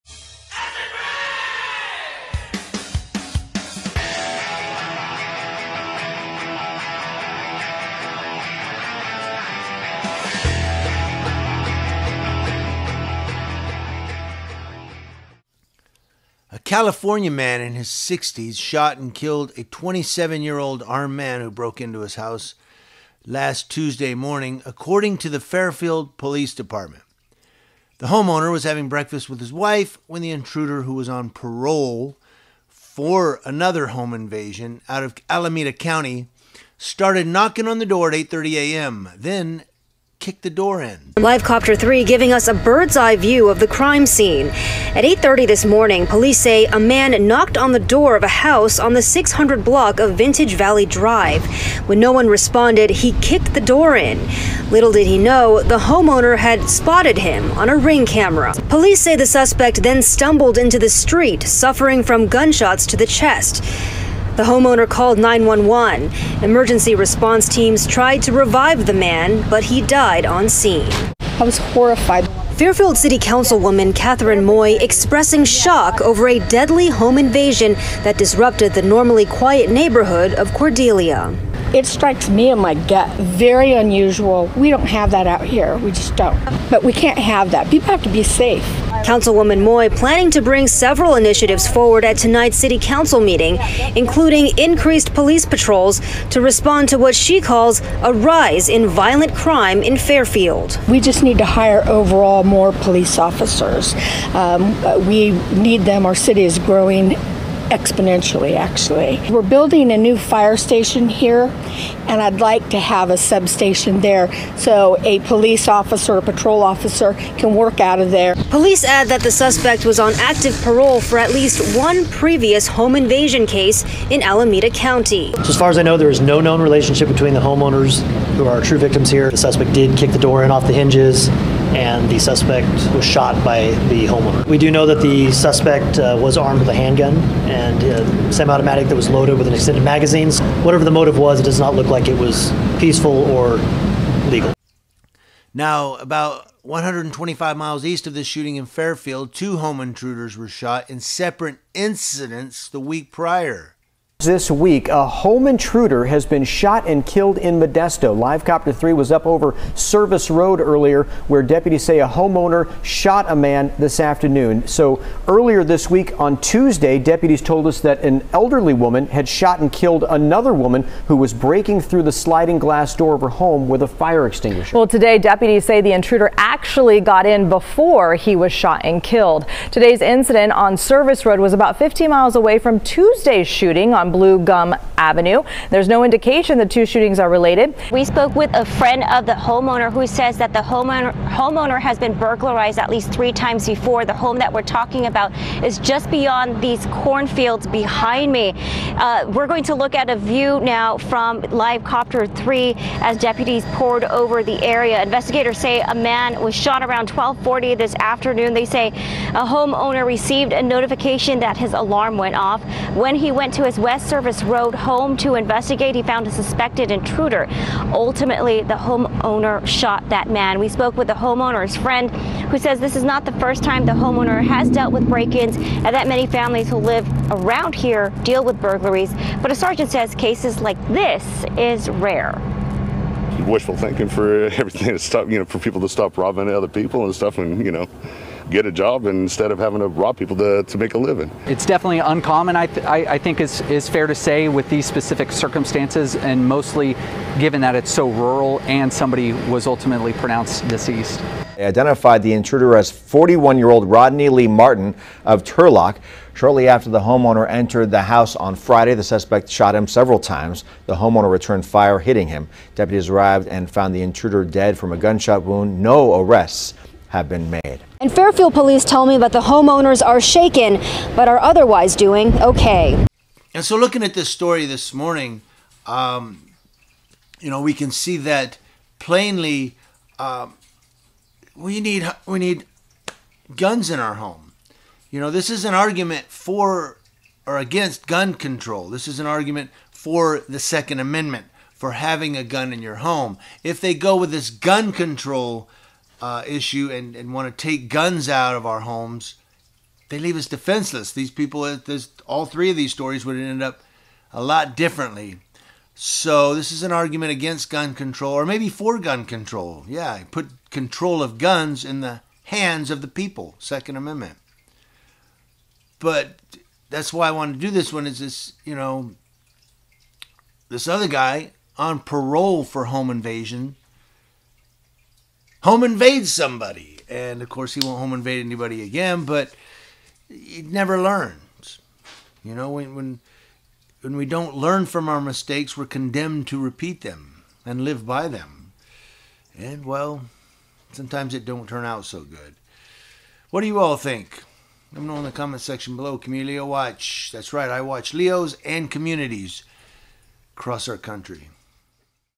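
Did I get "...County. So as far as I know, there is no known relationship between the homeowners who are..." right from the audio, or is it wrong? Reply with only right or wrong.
right.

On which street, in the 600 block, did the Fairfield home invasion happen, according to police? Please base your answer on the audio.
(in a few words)
Vintage Valley Drive.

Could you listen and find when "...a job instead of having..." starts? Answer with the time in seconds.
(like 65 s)
238 s.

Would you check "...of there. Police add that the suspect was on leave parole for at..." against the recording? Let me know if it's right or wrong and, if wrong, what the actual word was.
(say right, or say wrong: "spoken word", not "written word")
wrong: "active", not "leave".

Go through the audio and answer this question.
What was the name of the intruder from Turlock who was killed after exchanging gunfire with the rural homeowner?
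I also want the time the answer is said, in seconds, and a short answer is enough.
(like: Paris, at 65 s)
Rodney Lee Martin, at 253 s.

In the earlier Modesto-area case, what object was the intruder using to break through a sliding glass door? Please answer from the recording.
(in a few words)
fire extinguisher.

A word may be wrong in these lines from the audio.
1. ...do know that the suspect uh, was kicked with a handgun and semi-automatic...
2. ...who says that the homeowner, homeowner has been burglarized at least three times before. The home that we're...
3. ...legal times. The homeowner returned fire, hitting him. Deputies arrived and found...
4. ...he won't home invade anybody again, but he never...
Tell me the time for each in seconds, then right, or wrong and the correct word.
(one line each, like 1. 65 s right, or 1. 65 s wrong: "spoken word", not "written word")
1. 134 s wrong: "armed", not "kicked"
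2. 189 s right
3. 259 s wrong: "several", not "legal"
4. 327 s right.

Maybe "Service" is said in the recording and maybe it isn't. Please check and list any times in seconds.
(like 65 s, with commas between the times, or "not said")
159 s, 180 s, 214 s.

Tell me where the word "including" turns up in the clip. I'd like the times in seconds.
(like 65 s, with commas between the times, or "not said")
93 s.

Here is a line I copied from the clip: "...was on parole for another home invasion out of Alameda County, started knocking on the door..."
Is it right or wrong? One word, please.
right.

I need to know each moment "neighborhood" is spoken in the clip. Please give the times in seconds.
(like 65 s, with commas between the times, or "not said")
79 s.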